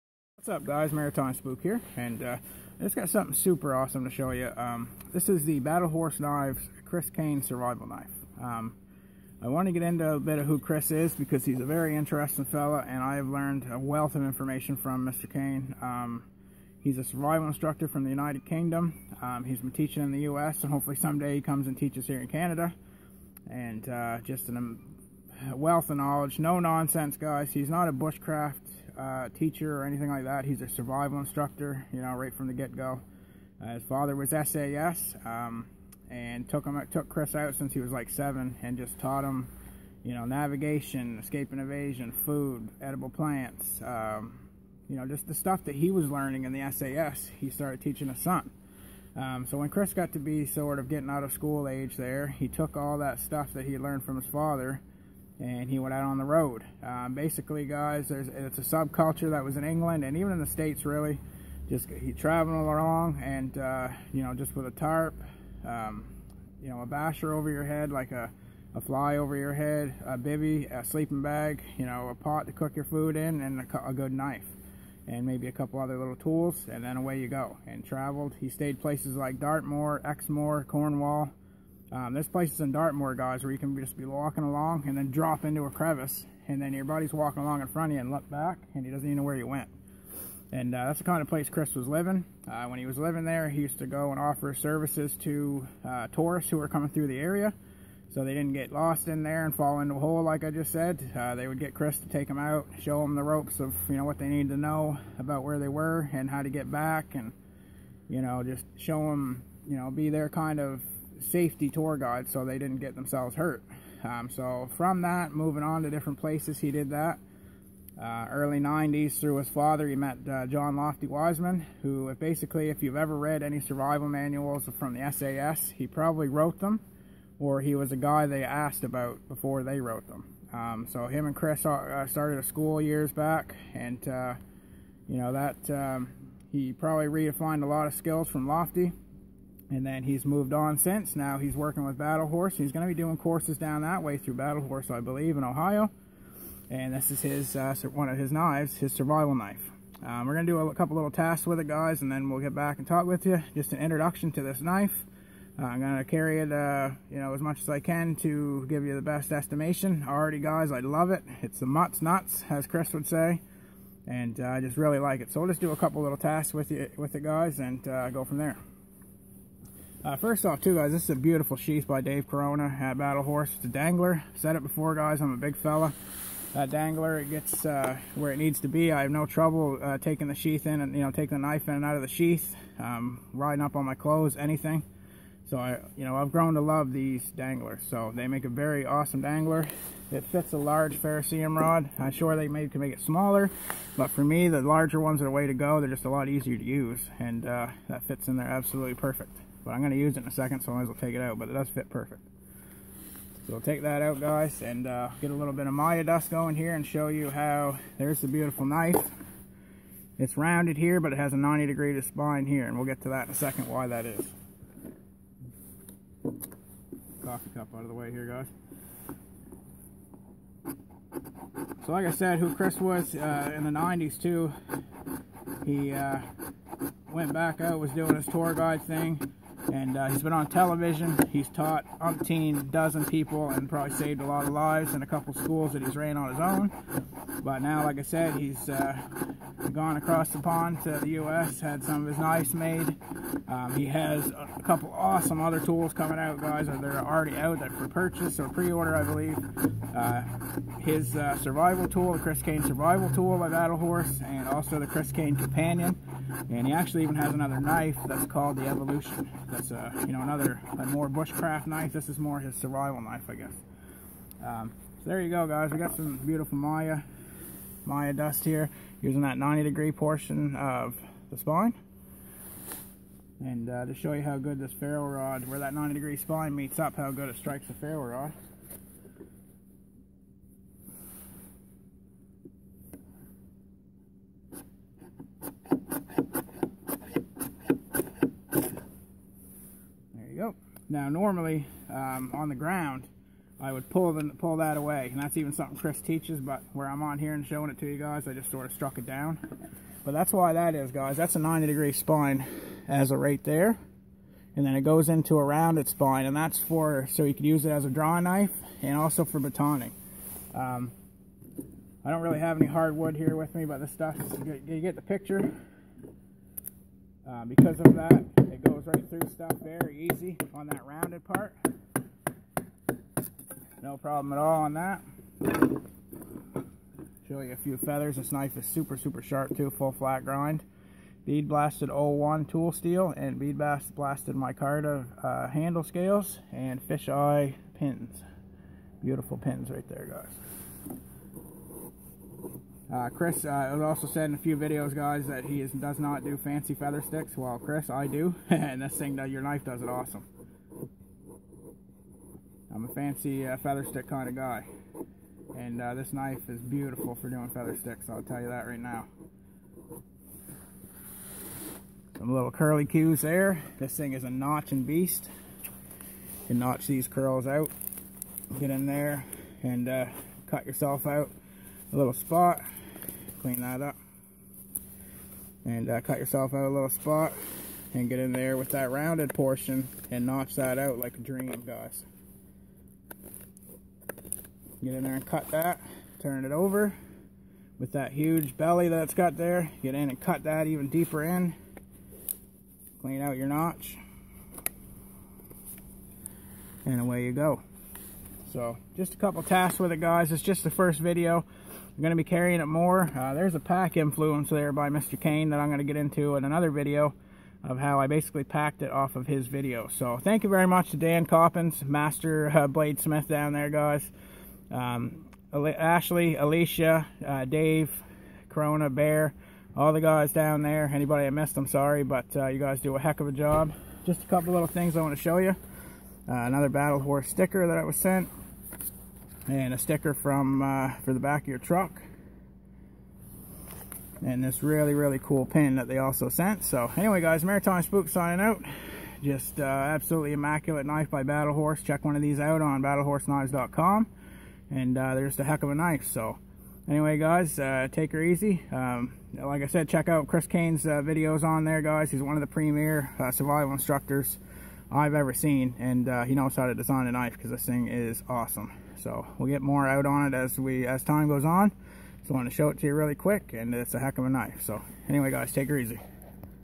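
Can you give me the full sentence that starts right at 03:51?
He's taught umpteen dozen people and probably saved a lot of lives in a couple schools that he's ran on his own.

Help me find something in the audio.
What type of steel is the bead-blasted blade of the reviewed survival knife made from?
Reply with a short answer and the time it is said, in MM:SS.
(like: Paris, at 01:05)
O1 tool steel, at 05:31.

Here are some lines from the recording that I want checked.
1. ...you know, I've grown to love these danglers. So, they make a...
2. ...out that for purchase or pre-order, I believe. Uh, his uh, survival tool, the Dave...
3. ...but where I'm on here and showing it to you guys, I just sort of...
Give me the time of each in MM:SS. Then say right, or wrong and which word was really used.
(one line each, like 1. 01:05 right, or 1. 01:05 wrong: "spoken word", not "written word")
1. 03:05 right
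2. 04:07 wrong: "Chris", not "Dave"
3. 04:56 right.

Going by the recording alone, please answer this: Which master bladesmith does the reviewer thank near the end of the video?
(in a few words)
Dan Coppins.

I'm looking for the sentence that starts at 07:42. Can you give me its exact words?
So I want to show it to you really quick, and it's a heck of a knife.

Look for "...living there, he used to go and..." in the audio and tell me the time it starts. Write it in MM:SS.
01:32.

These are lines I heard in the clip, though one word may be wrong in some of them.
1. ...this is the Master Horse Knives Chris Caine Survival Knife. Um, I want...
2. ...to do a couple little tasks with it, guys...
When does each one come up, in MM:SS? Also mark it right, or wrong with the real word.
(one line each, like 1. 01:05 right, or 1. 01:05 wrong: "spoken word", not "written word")
1. 00:05 wrong: "Battle", not "Master"
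2. 02:30 right.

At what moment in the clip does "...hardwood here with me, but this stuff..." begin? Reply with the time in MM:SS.
05:12.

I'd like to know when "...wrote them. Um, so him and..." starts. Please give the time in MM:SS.
02:09.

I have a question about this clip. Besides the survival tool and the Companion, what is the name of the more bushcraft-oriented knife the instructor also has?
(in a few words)
Evolution.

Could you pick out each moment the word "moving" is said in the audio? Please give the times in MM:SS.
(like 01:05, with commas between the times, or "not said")
01:55.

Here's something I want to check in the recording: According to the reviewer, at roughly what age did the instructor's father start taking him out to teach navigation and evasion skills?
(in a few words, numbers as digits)
7.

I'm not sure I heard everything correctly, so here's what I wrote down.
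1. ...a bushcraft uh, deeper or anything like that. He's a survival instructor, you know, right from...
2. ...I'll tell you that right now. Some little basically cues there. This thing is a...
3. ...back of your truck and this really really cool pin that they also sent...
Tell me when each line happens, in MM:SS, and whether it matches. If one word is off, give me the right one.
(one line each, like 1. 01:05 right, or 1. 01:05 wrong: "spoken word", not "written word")
1. 00:27 wrong: "teacher", not "deeper"
2. 05:58 wrong: "curly", not "basically"
3. 07:11 right.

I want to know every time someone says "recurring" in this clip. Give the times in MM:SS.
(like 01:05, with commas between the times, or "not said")
not said.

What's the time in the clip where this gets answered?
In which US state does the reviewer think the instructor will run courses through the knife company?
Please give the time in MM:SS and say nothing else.
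02:25.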